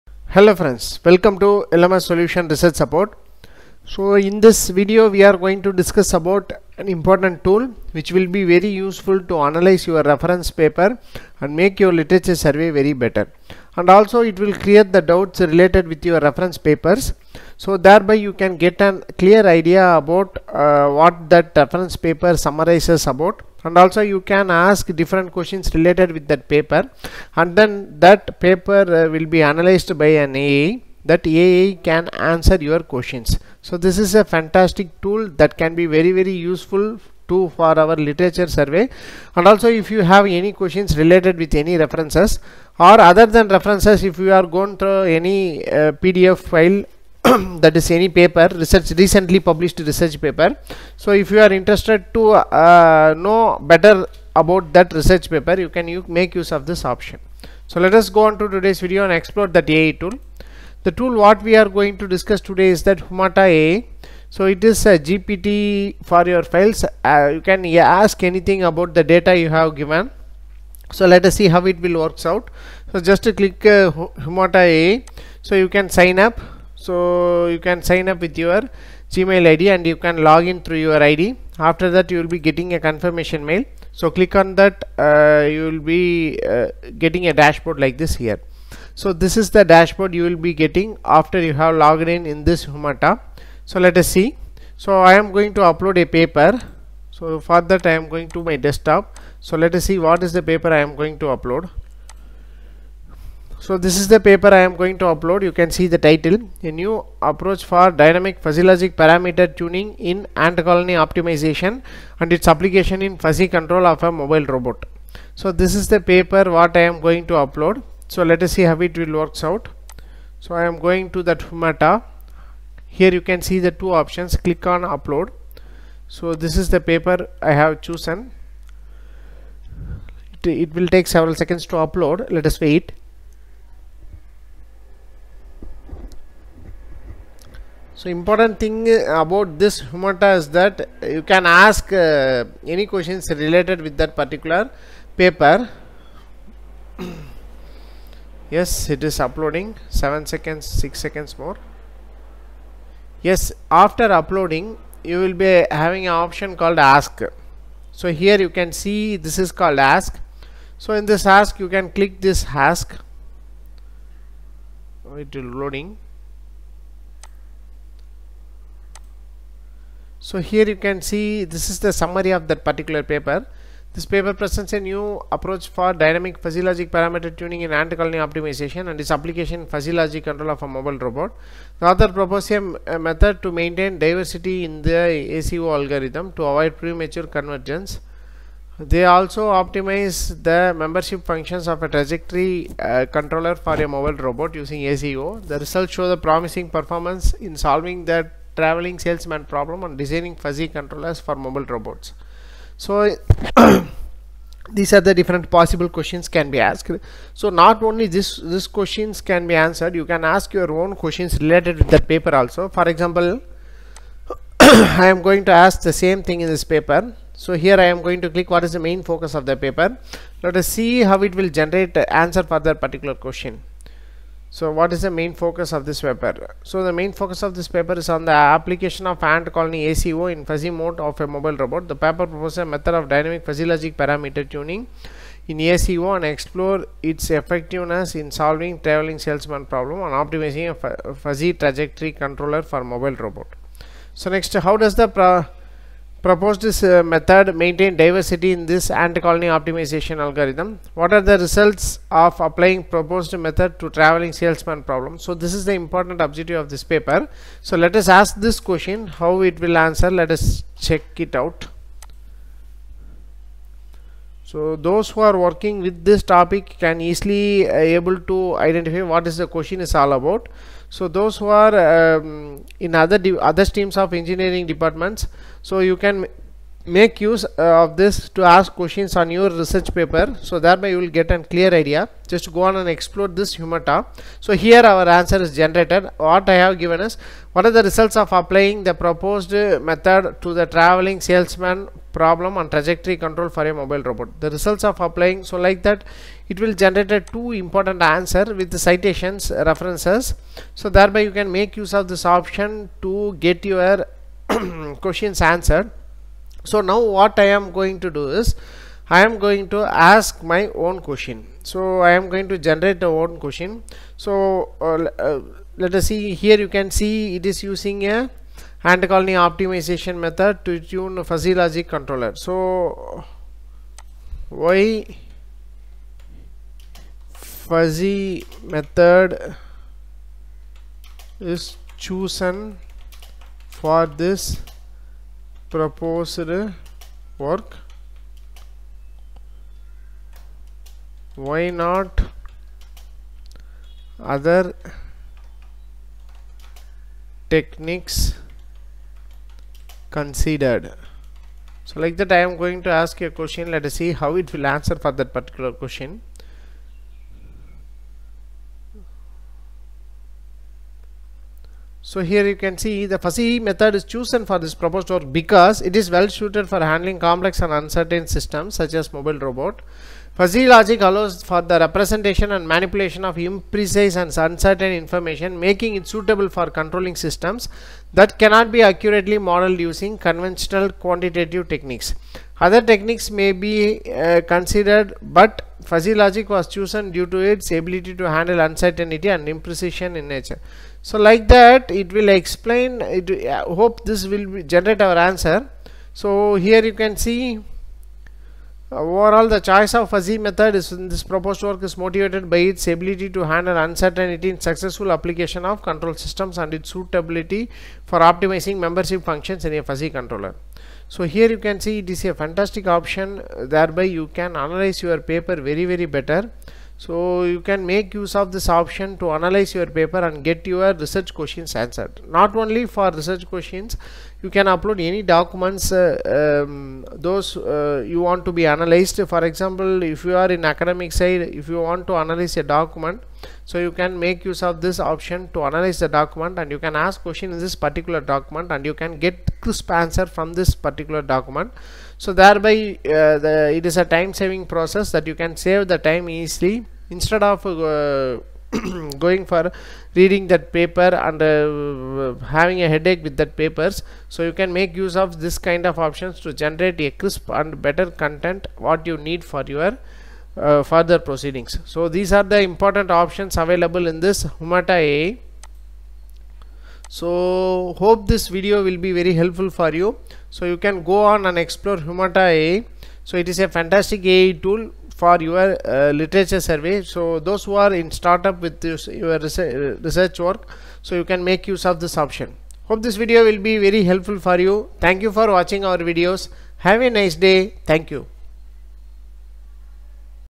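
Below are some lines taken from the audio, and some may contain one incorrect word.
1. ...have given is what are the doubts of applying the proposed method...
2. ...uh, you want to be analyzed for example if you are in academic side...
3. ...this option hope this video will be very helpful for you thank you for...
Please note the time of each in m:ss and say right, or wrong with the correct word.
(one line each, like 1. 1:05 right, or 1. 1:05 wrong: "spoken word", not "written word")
1. 4:46 wrong: "results", not "doubts"
2. 7:07 right
3. 8:01 right.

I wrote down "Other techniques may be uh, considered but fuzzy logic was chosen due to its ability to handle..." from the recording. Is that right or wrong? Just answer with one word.
right.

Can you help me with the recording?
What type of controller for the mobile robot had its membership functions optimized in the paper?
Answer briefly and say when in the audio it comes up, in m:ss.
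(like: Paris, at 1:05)
Trajectory controller, at 3:11.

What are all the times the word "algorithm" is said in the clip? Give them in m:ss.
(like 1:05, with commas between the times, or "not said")
3:05, 4:10.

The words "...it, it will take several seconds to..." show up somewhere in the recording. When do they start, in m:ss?
2:10.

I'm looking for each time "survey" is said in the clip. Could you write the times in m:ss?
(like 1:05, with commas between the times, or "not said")
0:12, 0:38, 7:56.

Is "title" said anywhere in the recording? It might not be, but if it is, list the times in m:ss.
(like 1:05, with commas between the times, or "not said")
1:46.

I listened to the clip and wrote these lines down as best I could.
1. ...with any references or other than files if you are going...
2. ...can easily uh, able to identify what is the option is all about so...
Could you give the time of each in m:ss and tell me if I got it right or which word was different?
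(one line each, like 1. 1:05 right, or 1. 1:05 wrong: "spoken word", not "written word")
1. 0:41 wrong: "references", not "files"
2. 4:26 wrong: "question", not "option".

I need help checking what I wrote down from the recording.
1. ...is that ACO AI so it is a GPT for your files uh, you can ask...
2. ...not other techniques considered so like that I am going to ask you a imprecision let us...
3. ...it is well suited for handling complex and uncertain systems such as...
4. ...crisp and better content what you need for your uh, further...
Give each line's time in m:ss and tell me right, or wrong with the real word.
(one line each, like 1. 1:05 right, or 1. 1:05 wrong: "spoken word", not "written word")
1. 1:02 wrong: "Humata", not "ACO"
2. 5:41 wrong: "question", not "imprecision"
3. 6:05 right
4. 7:37 right.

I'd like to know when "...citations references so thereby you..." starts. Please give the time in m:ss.
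4:58.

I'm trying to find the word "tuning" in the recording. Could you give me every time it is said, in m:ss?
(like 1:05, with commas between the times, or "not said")
1:49, 2:57, 3:54.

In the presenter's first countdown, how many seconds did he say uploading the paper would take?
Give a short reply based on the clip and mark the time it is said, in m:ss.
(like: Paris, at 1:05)
7, at 2:29.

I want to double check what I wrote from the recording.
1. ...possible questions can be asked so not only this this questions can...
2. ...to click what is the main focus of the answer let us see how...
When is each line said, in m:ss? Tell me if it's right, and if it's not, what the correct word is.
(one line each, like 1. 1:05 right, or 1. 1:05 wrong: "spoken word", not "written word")
1. 3:25 right
2. 3:38 wrong: "paper", not "answer".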